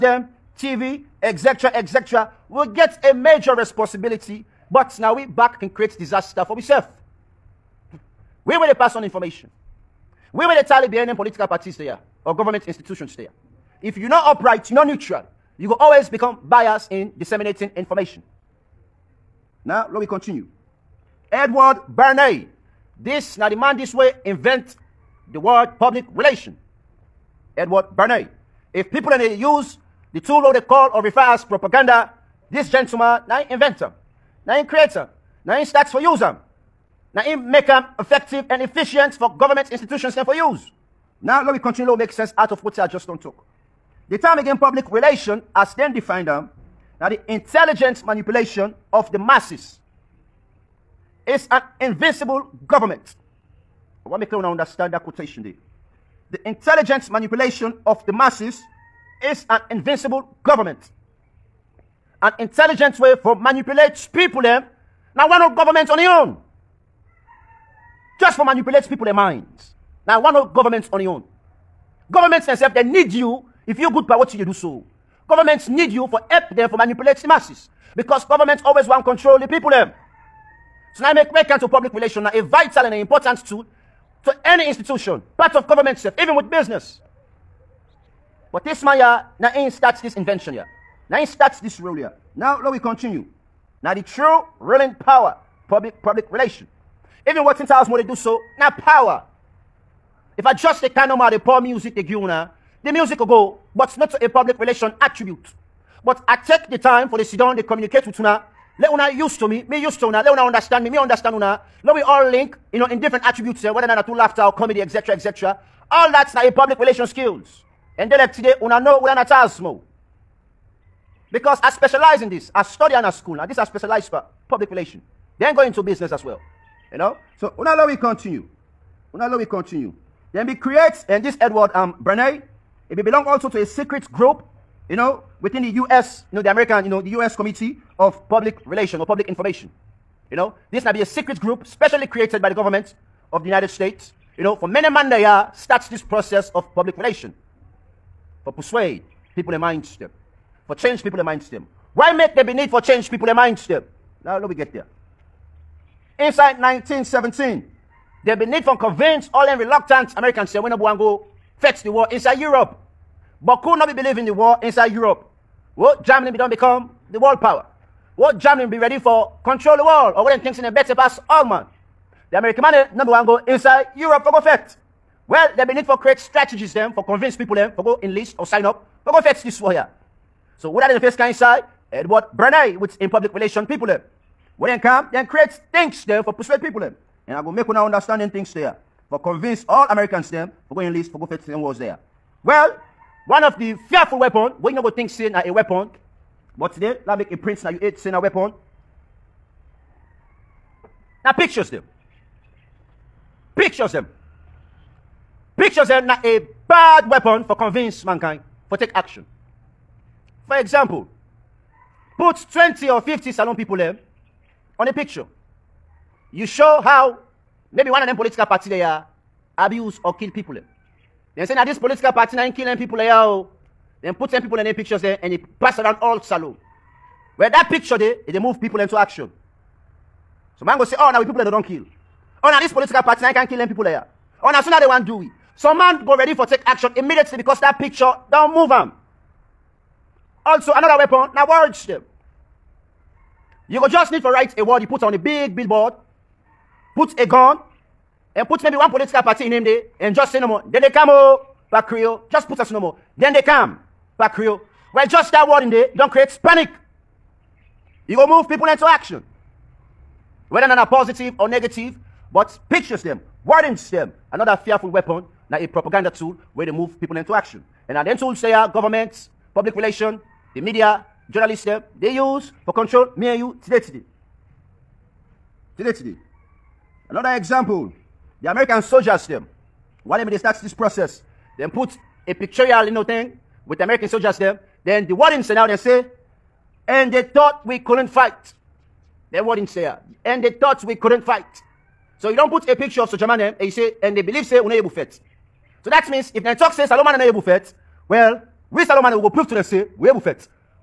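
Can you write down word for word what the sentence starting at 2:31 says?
Why make there be need for change people in mind them?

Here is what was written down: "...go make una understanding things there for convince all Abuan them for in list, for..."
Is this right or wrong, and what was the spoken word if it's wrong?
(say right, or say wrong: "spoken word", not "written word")
wrong: "Americans", not "Abuan".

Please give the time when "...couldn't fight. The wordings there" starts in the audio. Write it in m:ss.
4:47.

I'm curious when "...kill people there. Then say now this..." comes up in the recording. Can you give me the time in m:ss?
3:40.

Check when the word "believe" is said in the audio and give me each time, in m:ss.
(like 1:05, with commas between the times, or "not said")
2:43, 4:54.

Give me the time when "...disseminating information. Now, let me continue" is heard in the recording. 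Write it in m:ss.
0:17.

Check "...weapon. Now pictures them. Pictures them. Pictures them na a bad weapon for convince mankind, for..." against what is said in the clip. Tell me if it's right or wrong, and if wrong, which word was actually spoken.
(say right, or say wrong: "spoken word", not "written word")
right.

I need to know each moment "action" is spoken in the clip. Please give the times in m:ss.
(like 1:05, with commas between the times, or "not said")
3:28, 3:48, 3:56, 4:18, 4:27.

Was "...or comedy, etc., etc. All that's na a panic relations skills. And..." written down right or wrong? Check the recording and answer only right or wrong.
wrong.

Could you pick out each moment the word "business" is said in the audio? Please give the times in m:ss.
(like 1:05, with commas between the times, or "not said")
1:26, 2:05.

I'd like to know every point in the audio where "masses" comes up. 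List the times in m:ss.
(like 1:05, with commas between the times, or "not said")
0:49, 0:58, 1:17.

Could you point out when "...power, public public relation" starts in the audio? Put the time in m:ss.
1:34.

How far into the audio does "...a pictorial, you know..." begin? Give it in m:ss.
4:42.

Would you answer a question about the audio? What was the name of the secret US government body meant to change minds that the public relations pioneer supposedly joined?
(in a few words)
U.S. Committee of Public Relation.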